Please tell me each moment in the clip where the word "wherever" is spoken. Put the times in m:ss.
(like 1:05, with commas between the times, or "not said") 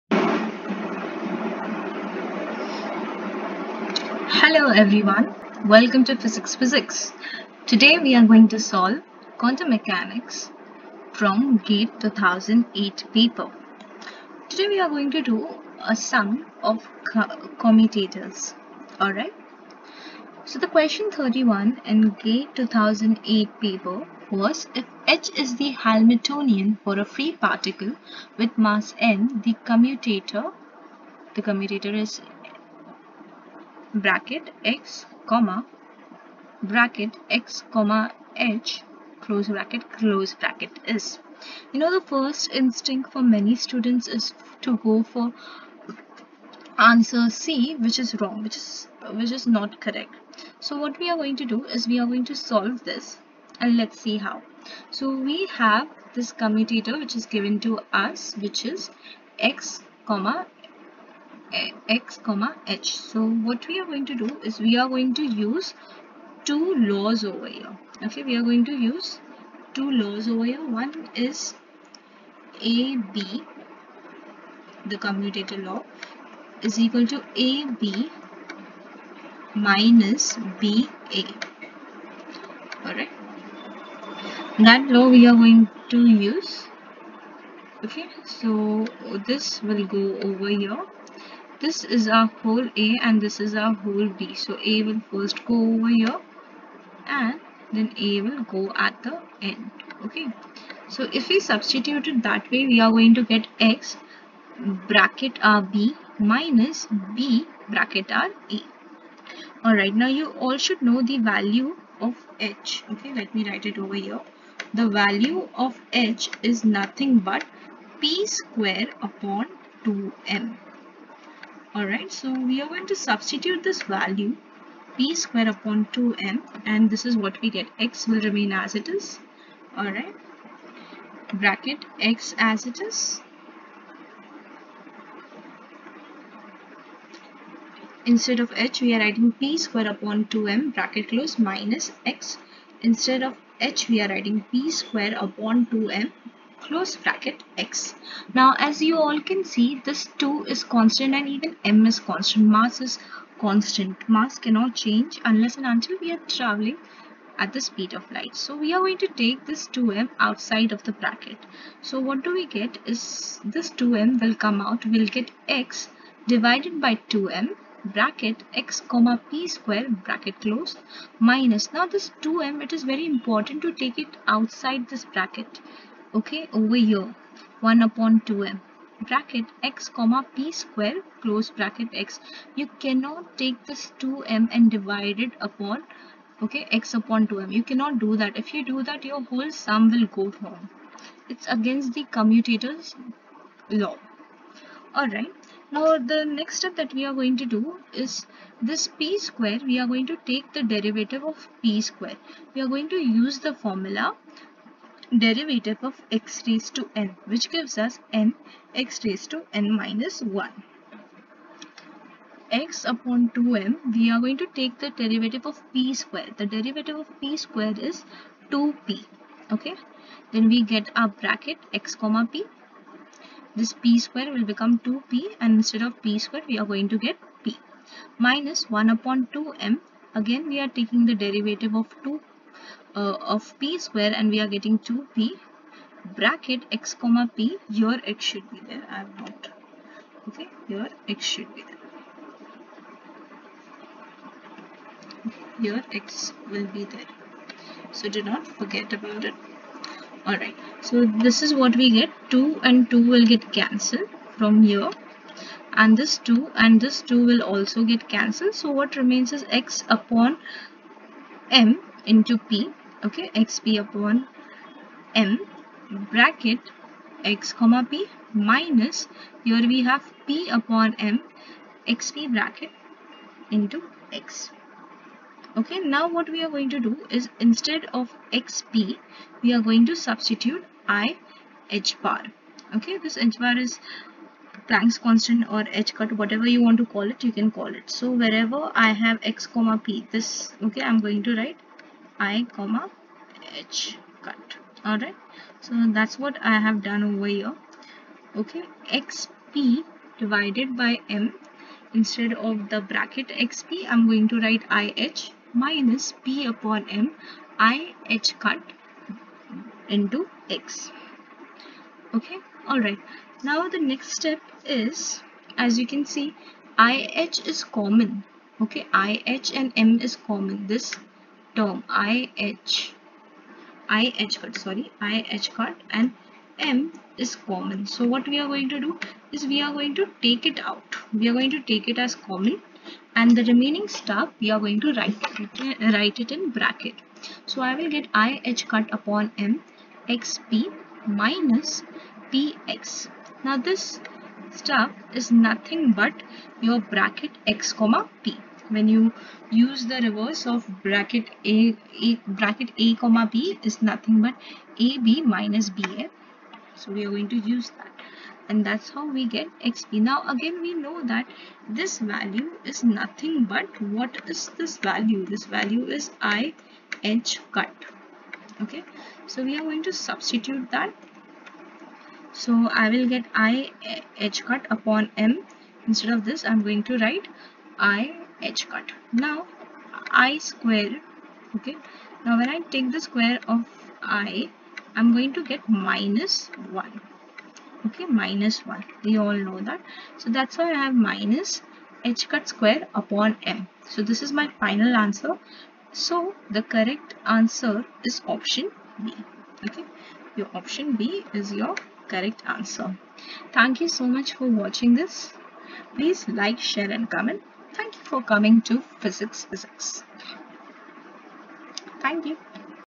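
4:48.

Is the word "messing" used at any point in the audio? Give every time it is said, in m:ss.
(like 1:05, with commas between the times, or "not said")
not said.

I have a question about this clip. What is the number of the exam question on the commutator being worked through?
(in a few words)
31.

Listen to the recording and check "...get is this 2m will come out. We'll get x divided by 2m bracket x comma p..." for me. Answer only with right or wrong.
right.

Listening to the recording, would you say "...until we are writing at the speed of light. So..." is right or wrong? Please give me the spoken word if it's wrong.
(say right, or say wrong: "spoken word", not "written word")
wrong: "traveling", not "writing".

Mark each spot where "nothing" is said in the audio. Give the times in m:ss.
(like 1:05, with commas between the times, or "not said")
1:56, 5:45, 5:53, 6:02.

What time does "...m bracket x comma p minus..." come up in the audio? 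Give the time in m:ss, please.
4:25.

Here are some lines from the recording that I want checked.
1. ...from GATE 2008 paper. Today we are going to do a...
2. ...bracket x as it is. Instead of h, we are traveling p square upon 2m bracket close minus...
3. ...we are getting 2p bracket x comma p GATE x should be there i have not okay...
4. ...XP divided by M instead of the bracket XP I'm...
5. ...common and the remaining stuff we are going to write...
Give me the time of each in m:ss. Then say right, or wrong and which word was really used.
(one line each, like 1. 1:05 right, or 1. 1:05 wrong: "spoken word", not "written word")
1. 0:11 right
2. 2:11 wrong: "writing", not "traveling"
3. 3:54 wrong: "Your", not "GATE"
4. 4:58 right
5. 5:32 right.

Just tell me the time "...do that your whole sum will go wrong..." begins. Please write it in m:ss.
3:08.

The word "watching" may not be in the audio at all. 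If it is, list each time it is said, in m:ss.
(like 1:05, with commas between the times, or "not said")
6:44.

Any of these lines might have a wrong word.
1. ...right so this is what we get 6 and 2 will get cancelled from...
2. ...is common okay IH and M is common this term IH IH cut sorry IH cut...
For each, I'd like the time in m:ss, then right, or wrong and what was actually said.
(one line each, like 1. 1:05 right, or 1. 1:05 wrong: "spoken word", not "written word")
1. 4:10 wrong: "2", not "6"
2. 5:17 right.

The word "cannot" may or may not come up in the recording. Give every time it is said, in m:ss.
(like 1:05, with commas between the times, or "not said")
2:34, 3:02, 3:07.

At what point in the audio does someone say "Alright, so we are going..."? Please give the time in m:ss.
2:01.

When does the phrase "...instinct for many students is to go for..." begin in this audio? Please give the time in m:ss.
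0:42.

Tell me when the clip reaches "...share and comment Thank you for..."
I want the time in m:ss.
6:46.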